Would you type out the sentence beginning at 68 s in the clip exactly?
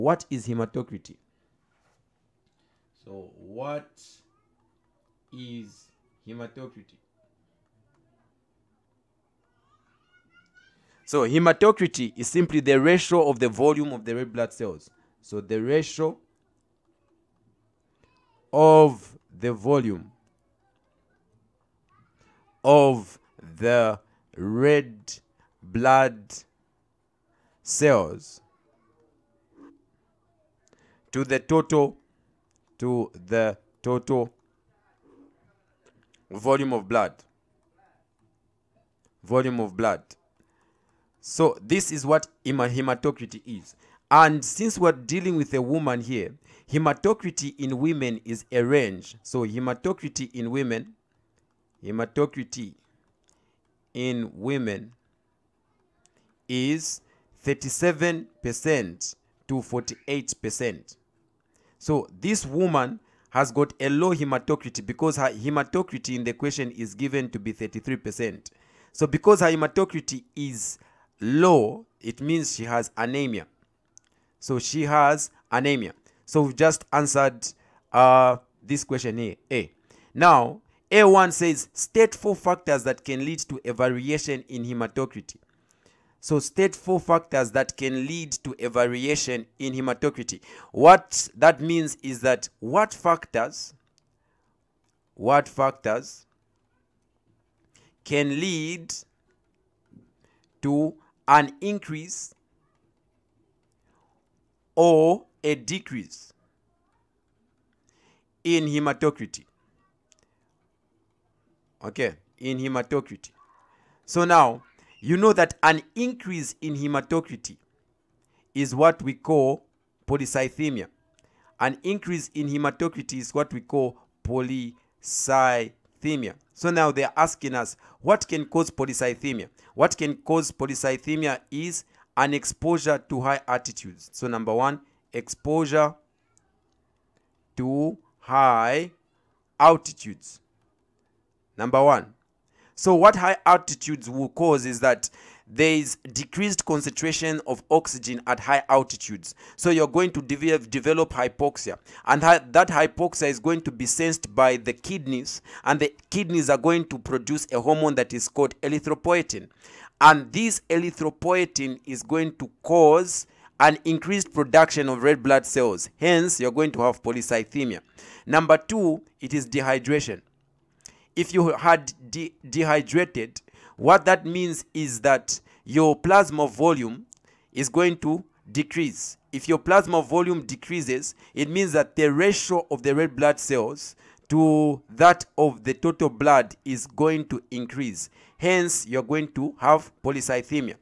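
So because her hematocrit is low, it means she has anemia.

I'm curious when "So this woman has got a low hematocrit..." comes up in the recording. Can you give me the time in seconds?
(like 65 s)
61 s.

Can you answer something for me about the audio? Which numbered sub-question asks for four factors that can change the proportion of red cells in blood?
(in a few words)
A1.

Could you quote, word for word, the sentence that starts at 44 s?
And since we're dealing with a woman here, hematocrity in women is a range.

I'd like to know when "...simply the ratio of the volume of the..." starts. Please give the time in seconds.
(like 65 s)
12 s.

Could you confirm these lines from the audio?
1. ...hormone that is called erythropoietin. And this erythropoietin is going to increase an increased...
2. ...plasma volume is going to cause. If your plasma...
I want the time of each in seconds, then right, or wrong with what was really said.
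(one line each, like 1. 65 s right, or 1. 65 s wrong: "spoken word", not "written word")
1. 157 s wrong: "cause", not "increase"
2. 175 s wrong: "decrease", not "cause".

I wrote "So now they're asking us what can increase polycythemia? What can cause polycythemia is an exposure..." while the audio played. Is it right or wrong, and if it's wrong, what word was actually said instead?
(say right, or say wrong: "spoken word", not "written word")
wrong: "cause", not "increase".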